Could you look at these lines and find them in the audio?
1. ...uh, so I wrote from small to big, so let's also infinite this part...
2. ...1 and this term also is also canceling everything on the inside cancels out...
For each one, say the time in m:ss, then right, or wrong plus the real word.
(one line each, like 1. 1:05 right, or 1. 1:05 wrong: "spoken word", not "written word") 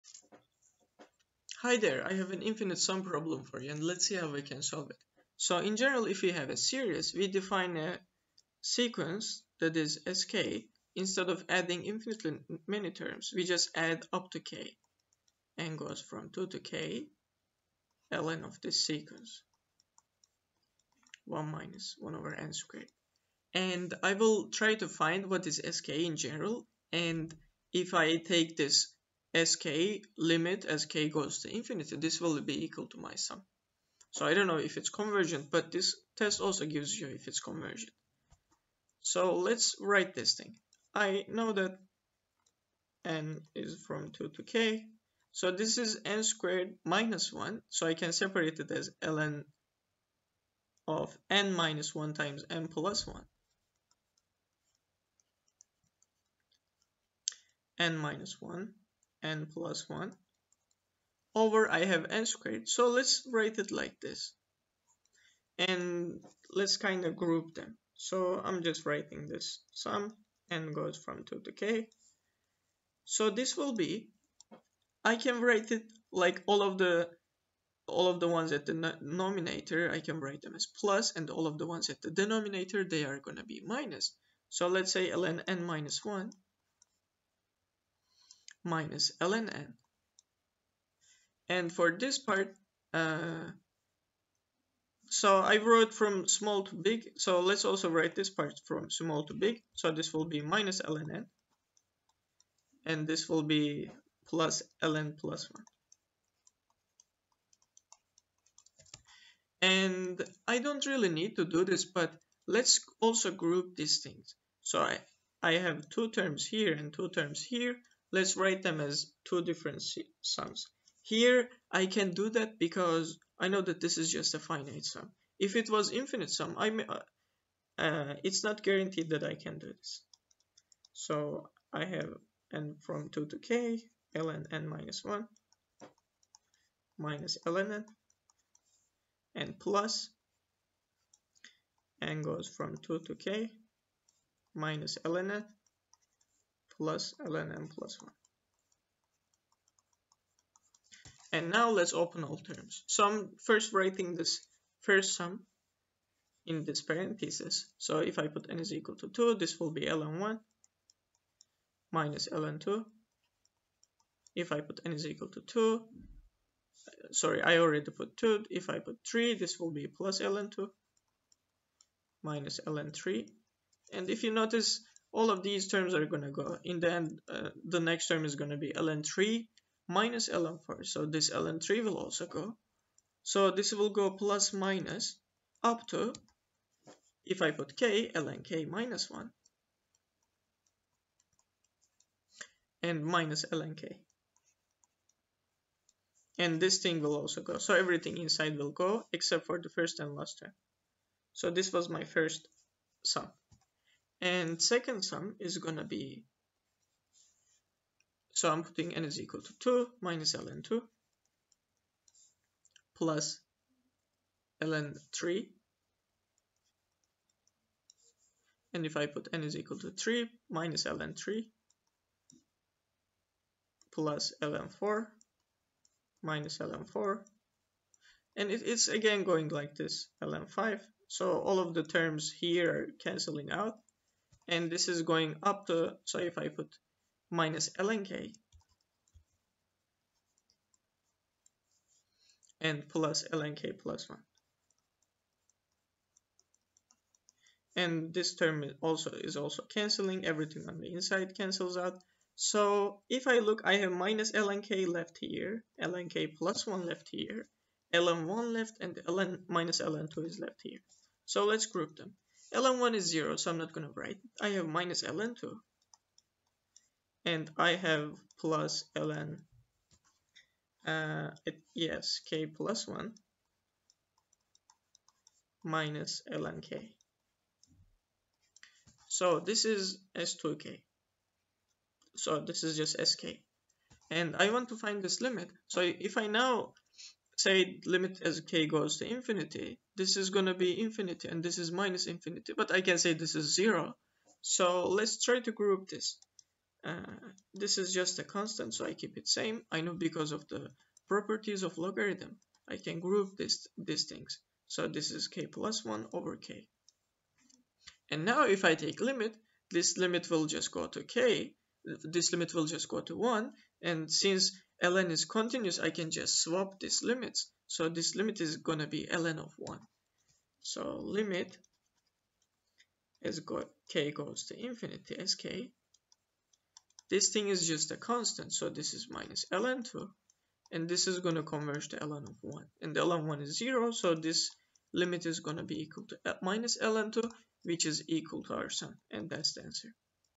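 1. 1:32 wrong: "write", not "infinite"
2. 4:04 right.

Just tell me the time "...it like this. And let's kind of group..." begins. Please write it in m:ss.
1:03.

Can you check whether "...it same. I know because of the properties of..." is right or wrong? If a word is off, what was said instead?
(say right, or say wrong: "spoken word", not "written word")
right.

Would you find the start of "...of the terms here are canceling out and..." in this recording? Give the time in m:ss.
3:51.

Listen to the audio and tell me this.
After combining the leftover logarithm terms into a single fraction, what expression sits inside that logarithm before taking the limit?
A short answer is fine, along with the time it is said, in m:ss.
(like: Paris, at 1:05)
(k+1)/k, at 5:05.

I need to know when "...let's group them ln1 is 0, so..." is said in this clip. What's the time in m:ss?
4:21.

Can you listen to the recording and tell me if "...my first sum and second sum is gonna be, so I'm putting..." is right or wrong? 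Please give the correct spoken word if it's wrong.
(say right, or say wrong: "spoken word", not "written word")
right.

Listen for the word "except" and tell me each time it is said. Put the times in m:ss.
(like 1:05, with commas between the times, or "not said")
3:19.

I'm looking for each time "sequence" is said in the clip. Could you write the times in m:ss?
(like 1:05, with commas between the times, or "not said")
0:08, 0:18.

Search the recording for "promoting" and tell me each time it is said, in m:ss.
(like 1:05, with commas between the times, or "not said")
not said.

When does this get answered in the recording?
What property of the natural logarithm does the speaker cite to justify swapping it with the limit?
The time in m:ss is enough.
5:15.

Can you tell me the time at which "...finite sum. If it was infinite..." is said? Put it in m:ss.
2:04.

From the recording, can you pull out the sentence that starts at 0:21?
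1 minus 1 over n squared.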